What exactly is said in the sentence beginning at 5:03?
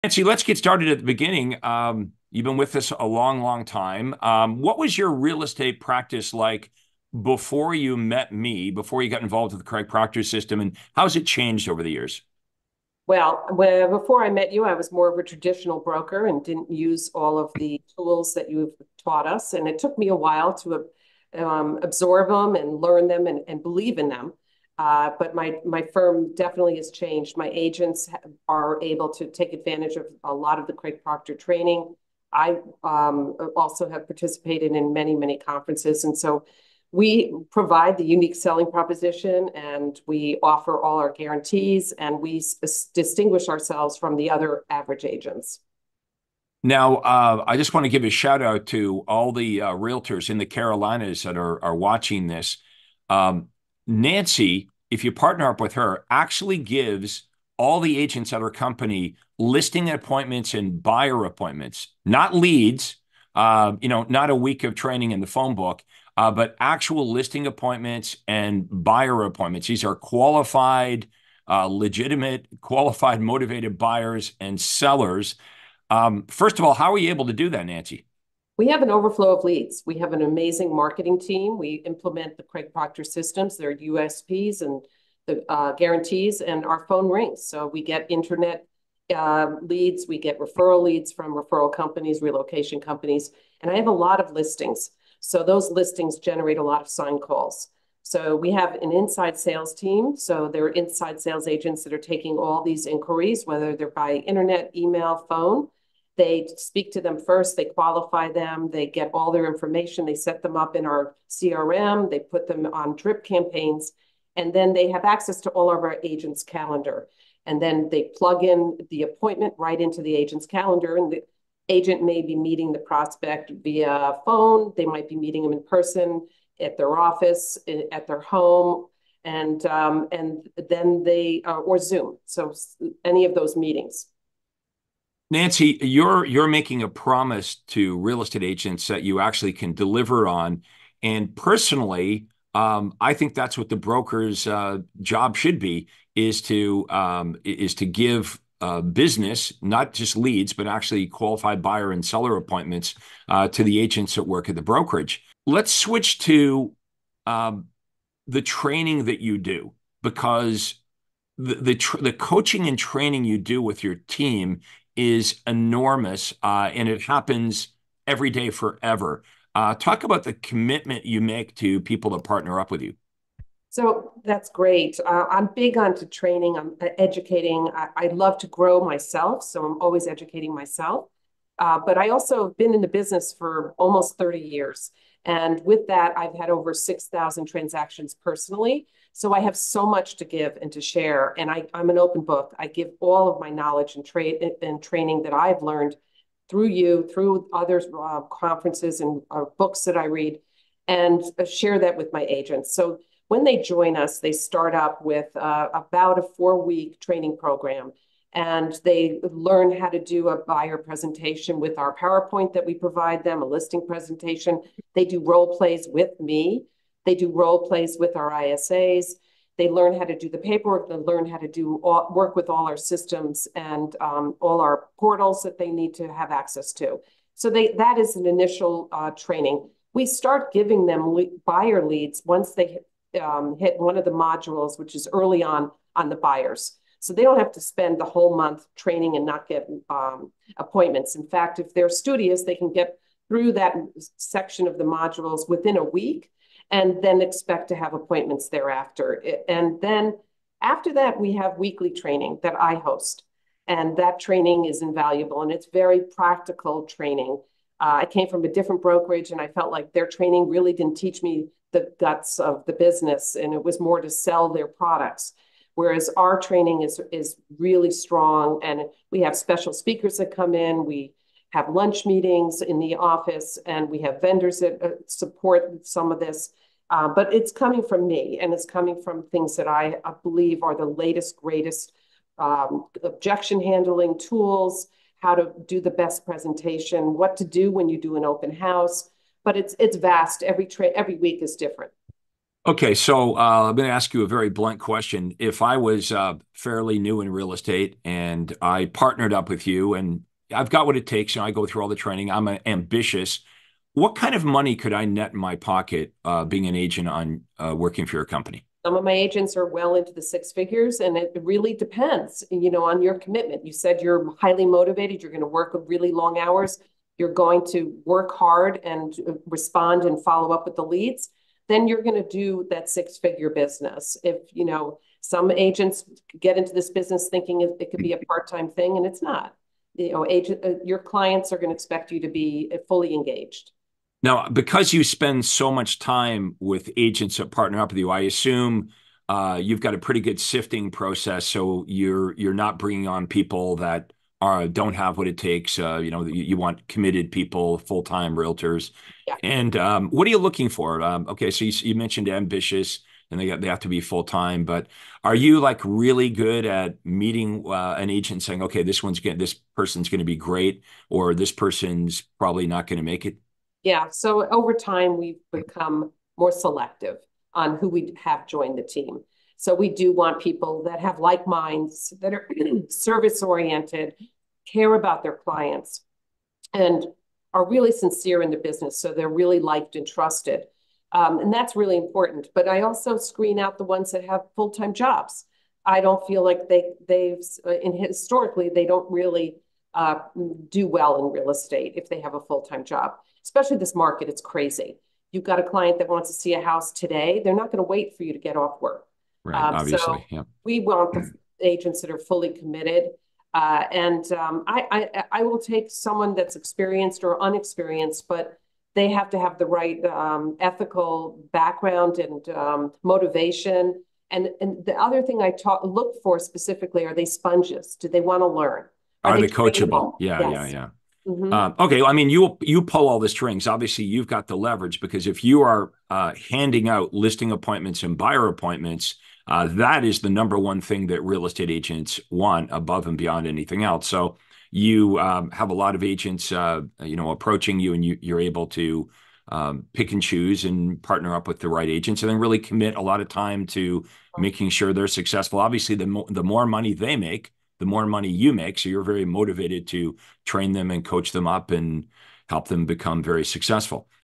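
What kind of money could I net in my pocket uh, being an agent on uh, working for your company?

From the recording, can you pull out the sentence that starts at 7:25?
Obviously, the mo- the more money they make, the more money you make.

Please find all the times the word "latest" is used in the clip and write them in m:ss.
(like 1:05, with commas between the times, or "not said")
4:40.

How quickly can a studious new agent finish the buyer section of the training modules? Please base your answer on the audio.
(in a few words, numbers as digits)
within a week.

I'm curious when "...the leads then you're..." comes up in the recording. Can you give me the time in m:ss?
5:20.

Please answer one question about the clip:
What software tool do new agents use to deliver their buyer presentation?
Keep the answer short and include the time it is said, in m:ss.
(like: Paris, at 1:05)
PowerPoint, at 3:31.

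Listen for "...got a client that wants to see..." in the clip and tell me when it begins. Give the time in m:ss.
6:35.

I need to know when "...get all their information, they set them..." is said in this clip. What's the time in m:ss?
1:48.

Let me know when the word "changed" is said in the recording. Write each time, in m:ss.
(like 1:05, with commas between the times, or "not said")
0:11, 0:26.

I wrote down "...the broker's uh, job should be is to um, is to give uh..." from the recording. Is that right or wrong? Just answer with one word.
right.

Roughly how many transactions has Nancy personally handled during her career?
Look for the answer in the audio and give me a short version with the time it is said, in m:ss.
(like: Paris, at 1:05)
over 6,000, at 3:06.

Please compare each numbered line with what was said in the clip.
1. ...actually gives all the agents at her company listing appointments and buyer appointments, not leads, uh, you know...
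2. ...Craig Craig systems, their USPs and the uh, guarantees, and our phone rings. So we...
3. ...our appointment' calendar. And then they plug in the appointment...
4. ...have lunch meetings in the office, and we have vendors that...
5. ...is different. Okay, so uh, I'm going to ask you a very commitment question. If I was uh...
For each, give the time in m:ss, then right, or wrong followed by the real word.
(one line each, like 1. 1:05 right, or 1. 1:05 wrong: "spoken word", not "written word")
1. 0:56 right
2. 1:22 wrong: "Proctor", not "Craig"
3. 1:55 wrong: "agents", not "appointment"
4. 4:31 right
5. 4:51 wrong: "blunt", not "commitment".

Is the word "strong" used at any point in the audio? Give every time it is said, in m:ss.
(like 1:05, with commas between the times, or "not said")
4:27.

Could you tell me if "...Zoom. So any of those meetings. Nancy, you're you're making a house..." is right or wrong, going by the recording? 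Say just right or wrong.
wrong.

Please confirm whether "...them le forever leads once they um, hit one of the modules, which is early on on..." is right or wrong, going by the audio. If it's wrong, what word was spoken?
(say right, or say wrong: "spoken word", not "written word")
wrong: "buyer", not "forever".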